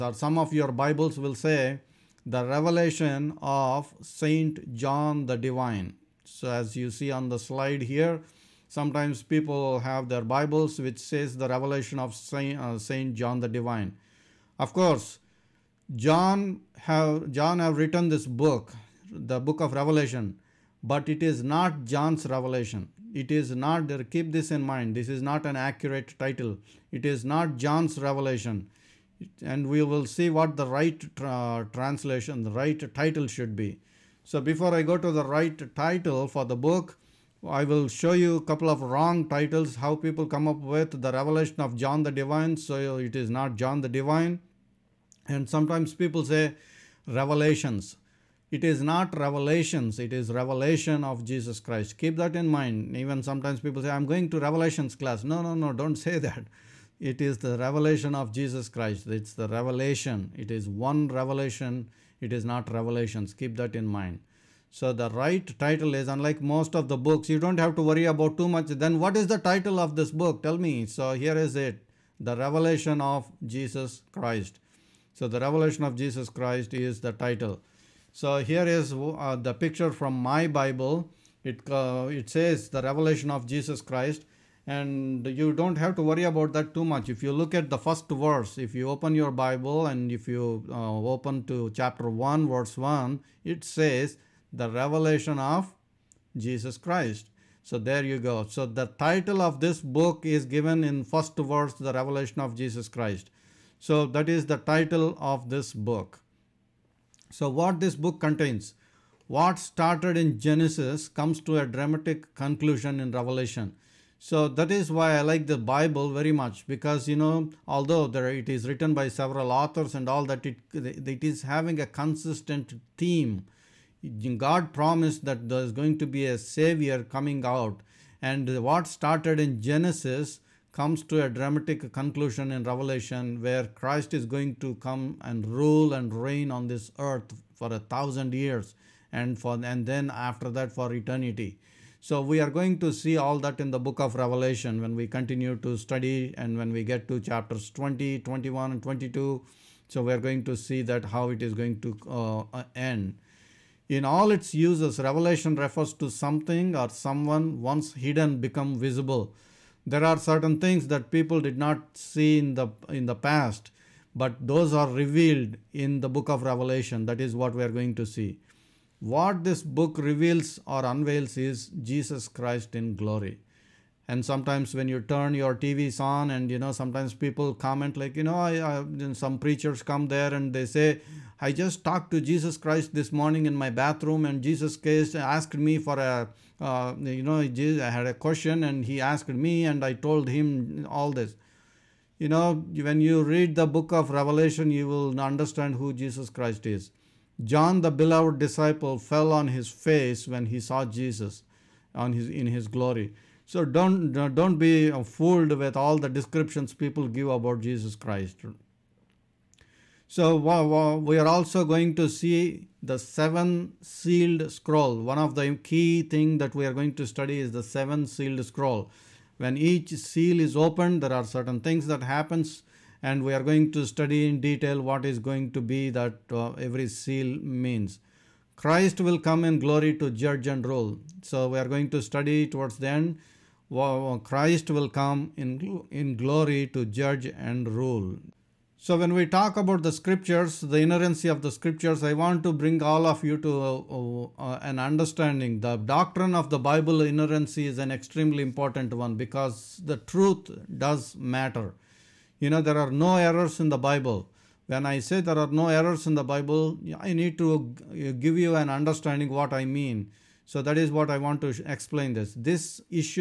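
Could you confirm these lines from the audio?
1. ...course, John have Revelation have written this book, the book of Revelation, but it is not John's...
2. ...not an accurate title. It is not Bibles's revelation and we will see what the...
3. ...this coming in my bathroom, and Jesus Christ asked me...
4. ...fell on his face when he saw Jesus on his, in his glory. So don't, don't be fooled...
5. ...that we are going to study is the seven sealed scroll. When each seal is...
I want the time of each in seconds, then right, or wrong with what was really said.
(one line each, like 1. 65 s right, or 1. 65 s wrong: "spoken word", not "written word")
1. 14 s wrong: "John", not "Revelation"
2. 25 s wrong: "John", not "Bibles"
3. 182 s wrong: "morning", not "coming"
4. 198 s right
5. 216 s right.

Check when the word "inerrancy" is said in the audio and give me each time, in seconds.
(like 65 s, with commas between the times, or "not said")
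240 s, 247 s.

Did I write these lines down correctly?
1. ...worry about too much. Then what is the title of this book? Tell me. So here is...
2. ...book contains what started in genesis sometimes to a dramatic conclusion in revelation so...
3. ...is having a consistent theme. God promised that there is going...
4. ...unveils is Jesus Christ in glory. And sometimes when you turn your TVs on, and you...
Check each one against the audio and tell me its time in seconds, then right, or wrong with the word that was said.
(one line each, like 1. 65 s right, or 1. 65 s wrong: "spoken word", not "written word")
1. 67 s right
2. 107 s wrong: "comes", not "sometimes"
3. 121 s right
4. 170 s right.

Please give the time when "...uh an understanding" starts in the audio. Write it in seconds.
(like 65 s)
244 s.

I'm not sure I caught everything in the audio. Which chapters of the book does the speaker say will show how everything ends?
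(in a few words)
20, 21 and 22.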